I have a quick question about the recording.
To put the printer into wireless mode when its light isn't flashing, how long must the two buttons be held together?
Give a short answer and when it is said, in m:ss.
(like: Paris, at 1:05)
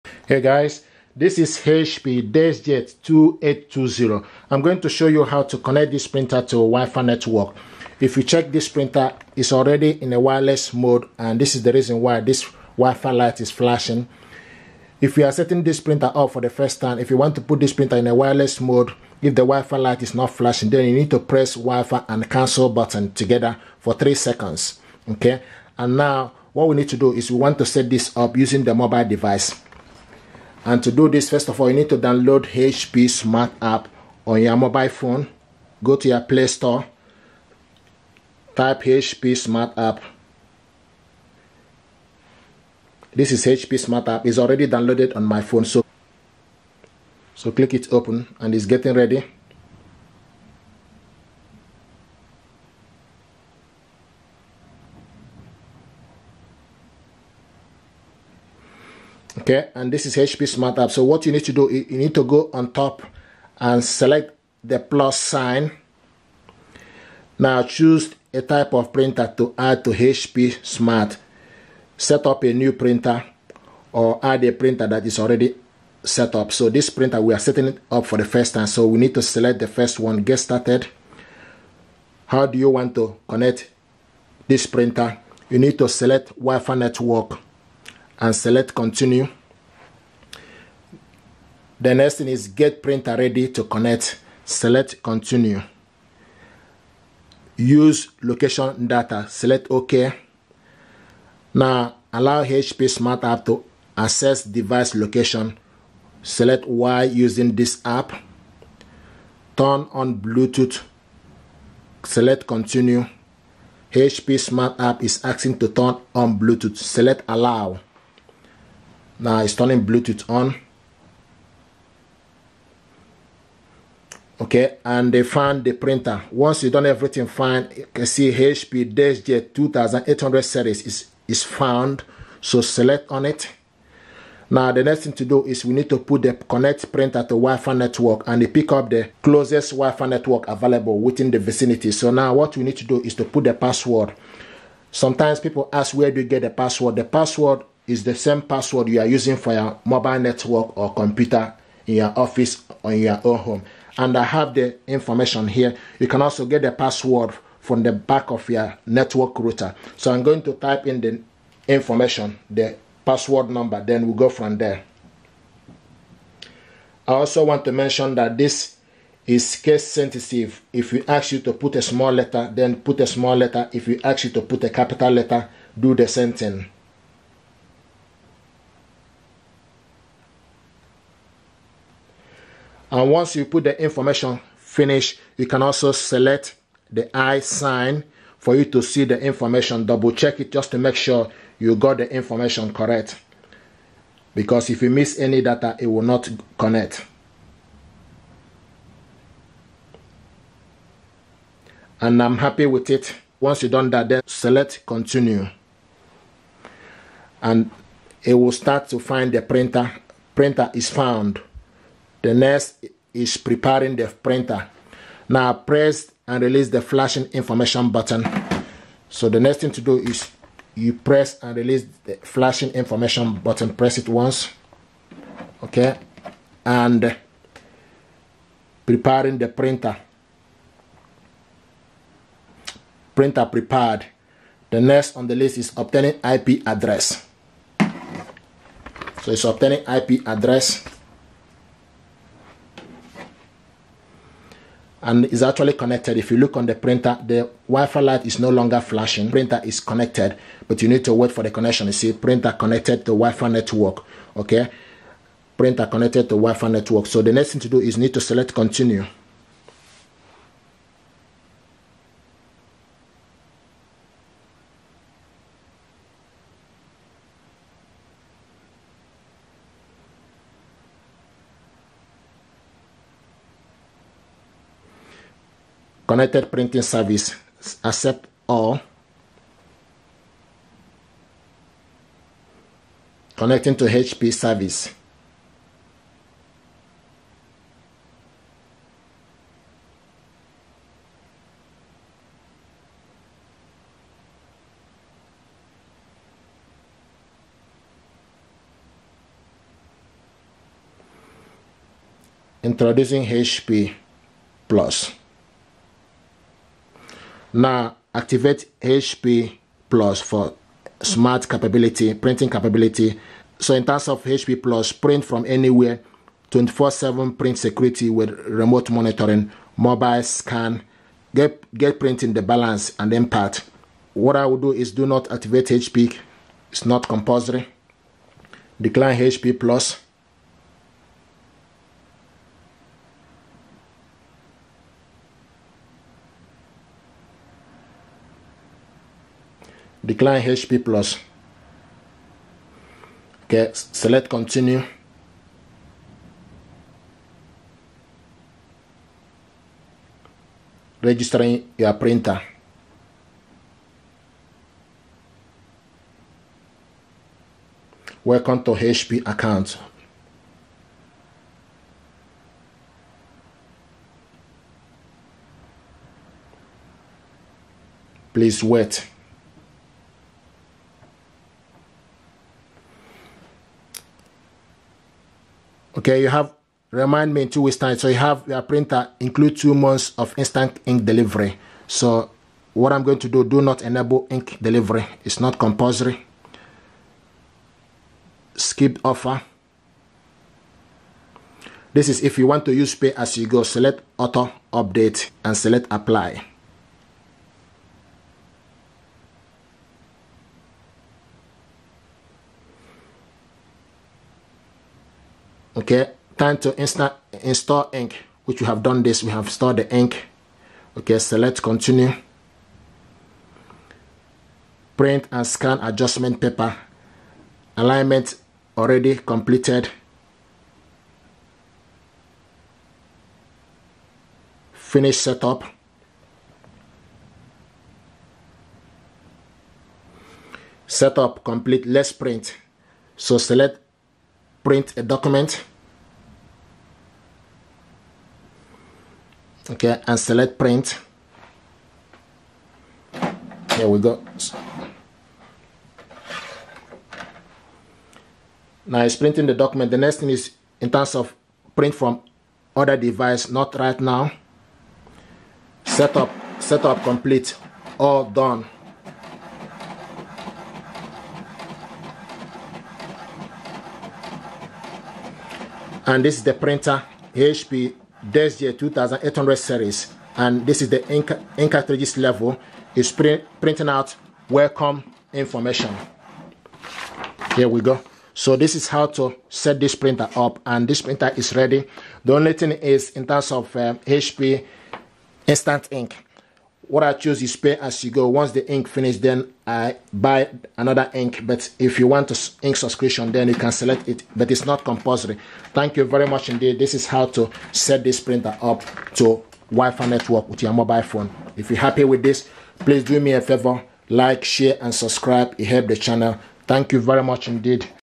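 3 seconds, at 0:23.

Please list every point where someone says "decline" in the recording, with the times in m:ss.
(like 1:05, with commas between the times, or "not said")
5:28, 5:40.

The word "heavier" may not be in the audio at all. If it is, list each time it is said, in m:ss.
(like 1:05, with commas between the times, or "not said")
not said.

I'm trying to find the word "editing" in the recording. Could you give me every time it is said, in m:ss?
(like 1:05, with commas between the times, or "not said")
not said.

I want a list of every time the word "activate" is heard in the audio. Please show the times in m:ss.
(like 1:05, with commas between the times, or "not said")
5:08, 5:25.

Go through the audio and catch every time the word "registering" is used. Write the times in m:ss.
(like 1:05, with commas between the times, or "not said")
5:51.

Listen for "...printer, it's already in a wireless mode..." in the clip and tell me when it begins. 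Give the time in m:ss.
0:08.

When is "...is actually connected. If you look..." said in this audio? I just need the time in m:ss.
4:05.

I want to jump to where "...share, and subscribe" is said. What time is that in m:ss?
8:24.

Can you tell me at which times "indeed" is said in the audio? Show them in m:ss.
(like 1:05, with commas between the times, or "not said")
8:16, 8:27.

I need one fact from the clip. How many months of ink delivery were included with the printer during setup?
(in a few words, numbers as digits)
2.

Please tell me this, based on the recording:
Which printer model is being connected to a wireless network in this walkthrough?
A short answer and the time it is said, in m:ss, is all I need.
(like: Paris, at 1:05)
HP DeskJet 2820, at 0:01.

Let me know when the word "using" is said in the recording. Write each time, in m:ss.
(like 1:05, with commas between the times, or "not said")
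0:28, 1:47, 2:29.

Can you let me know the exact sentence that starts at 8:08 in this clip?
Once the ink finished, then I buy another ink.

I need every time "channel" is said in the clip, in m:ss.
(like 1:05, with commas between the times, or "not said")
8:25.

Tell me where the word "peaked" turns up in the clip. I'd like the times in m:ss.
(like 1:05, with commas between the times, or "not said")
not said.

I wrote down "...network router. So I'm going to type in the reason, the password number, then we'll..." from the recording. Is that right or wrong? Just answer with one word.
wrong.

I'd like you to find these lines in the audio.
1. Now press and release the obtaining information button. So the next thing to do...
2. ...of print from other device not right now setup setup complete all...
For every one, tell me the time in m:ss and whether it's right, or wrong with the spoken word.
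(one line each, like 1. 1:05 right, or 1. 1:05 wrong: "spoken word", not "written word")
1. 3:35 wrong: "flashing", not "obtaining"
2. 7:31 right.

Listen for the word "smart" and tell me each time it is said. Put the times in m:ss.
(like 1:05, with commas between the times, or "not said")
0:33, 0:39, 0:43, 1:00, 1:10, 1:42, 1:54, 5:11.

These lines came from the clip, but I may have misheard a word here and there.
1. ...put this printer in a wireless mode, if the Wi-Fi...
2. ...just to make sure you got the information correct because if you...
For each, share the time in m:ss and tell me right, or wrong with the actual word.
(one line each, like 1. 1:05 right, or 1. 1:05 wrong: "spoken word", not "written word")
1. 0:17 right
2. 3:10 right.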